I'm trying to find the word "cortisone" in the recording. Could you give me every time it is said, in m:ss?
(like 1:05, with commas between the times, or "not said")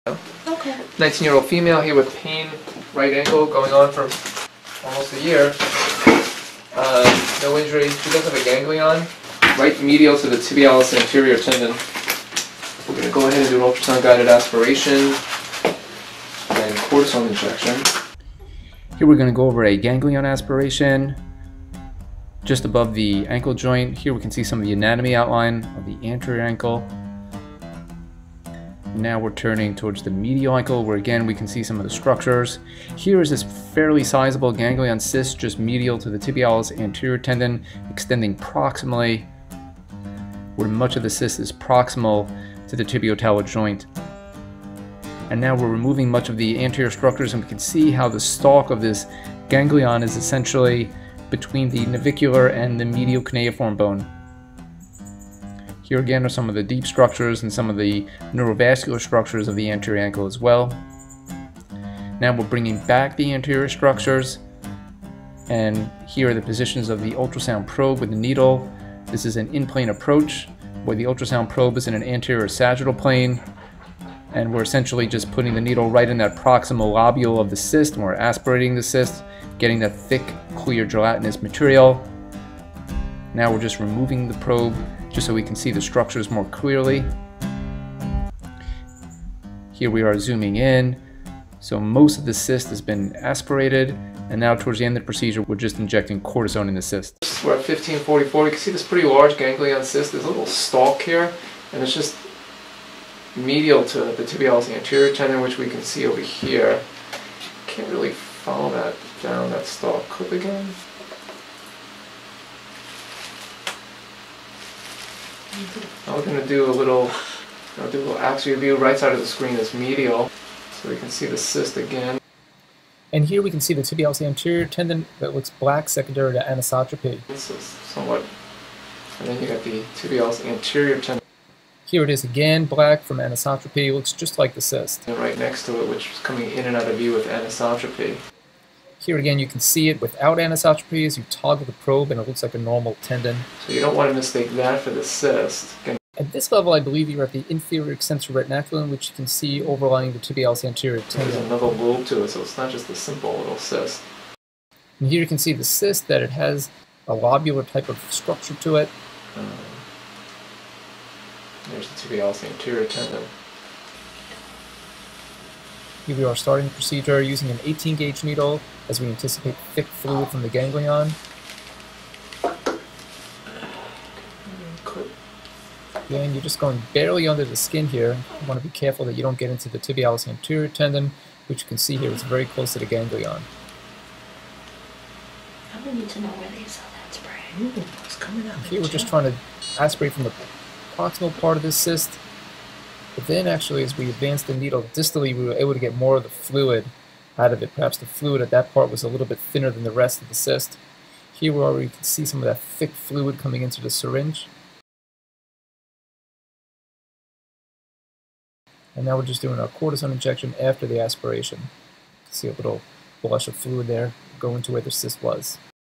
0:16, 1:36, 3:29.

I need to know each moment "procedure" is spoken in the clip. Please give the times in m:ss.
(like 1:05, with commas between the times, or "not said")
1:35, 2:46.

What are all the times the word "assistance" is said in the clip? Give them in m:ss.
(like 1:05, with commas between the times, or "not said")
not said.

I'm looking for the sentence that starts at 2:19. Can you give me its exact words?
Here again, you can see it without anisotropy as you toggle the probe and it looks like a normal tendon.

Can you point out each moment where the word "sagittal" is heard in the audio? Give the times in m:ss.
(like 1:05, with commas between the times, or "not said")
1:12.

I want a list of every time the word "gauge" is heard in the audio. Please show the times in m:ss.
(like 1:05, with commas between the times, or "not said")
2:47.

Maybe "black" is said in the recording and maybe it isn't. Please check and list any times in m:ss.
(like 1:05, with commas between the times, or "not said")
2:05, 2:12.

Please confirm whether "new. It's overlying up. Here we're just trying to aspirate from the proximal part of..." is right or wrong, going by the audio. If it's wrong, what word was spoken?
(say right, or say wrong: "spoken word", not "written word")
wrong: "coming", not "overlying".